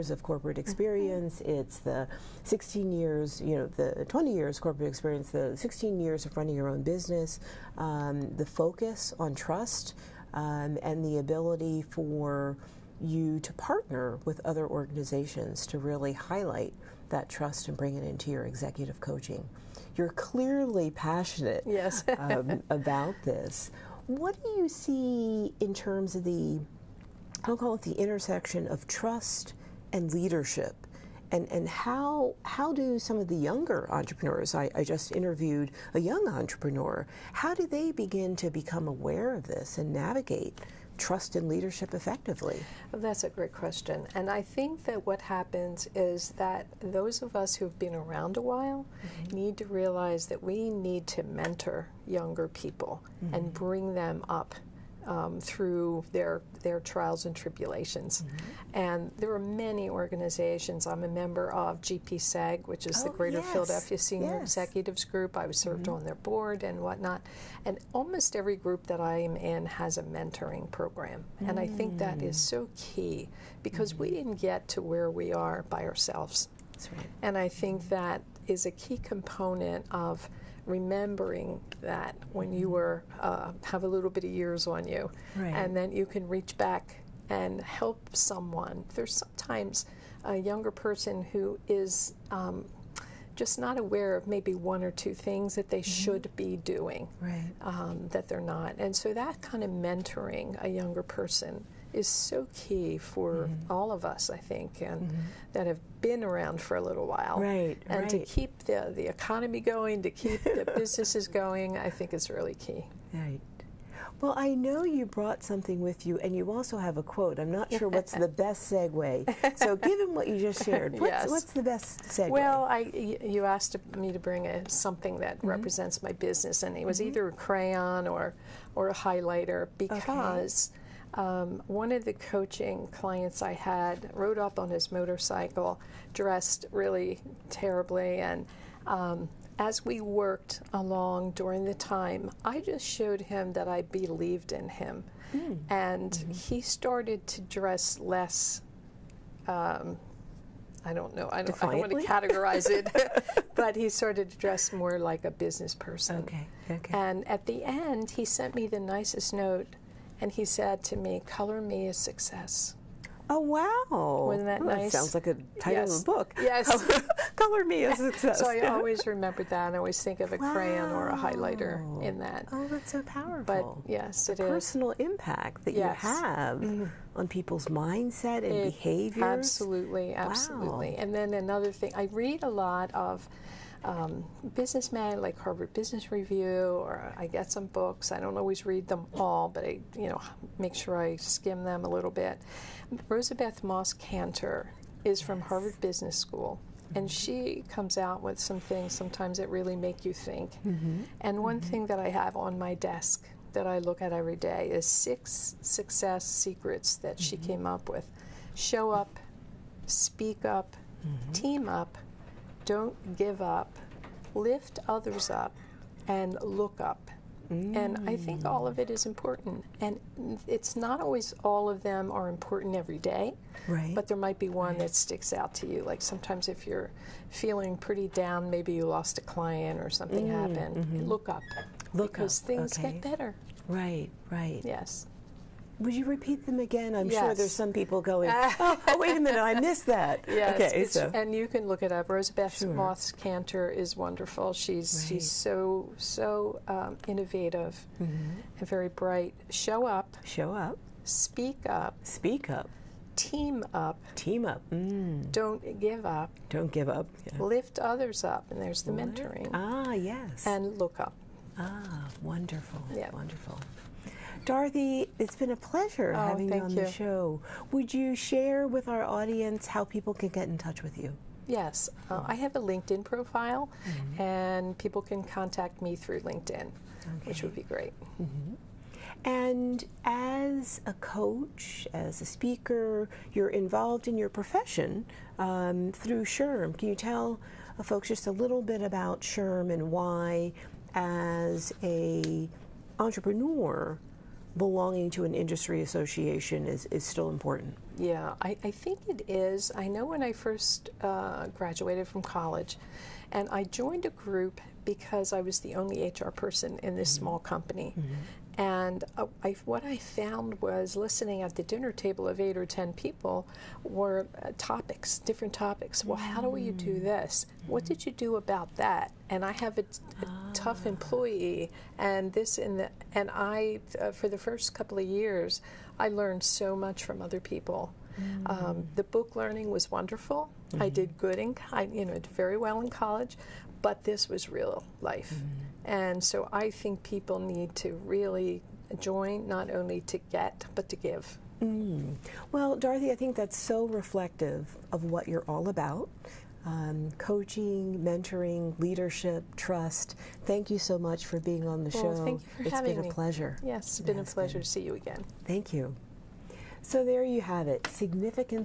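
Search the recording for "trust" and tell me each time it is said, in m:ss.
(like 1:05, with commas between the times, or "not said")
0:09, 0:17, 0:28, 0:40, 5:49.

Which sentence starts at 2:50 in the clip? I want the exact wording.
crayon or a highlighter in that.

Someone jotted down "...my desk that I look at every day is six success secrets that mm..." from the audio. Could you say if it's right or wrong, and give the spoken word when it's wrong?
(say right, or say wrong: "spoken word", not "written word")
right.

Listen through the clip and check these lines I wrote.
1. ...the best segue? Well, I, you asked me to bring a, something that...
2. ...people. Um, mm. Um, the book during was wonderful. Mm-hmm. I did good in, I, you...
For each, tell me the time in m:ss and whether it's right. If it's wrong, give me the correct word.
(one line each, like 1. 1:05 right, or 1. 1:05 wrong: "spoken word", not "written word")
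1. 2:01 right
2. 5:27 wrong: "learning", not "during".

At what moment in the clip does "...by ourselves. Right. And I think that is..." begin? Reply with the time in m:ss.
1:15.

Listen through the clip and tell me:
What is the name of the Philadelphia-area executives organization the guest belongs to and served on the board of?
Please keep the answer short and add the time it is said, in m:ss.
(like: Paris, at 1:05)
GPSEG, at 1:01.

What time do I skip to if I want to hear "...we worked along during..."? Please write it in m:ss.
2:19.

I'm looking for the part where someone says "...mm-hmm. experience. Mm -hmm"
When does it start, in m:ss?
0:00.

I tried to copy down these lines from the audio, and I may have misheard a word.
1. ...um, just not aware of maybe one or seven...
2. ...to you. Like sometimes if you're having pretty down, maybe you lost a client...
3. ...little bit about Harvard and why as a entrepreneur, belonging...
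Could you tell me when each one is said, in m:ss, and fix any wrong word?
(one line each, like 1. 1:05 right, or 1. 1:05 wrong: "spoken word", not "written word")
1. 1:32 wrong: "two", not "seven"
2. 3:45 wrong: "feeling", not "having"
3. 4:48 wrong: "SHRM", not "Harvard".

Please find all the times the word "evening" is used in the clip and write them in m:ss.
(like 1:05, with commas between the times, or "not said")
not said.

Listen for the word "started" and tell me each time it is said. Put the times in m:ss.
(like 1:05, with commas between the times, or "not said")
2:26, 2:33.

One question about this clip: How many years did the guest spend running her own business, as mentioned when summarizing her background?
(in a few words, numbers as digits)
16.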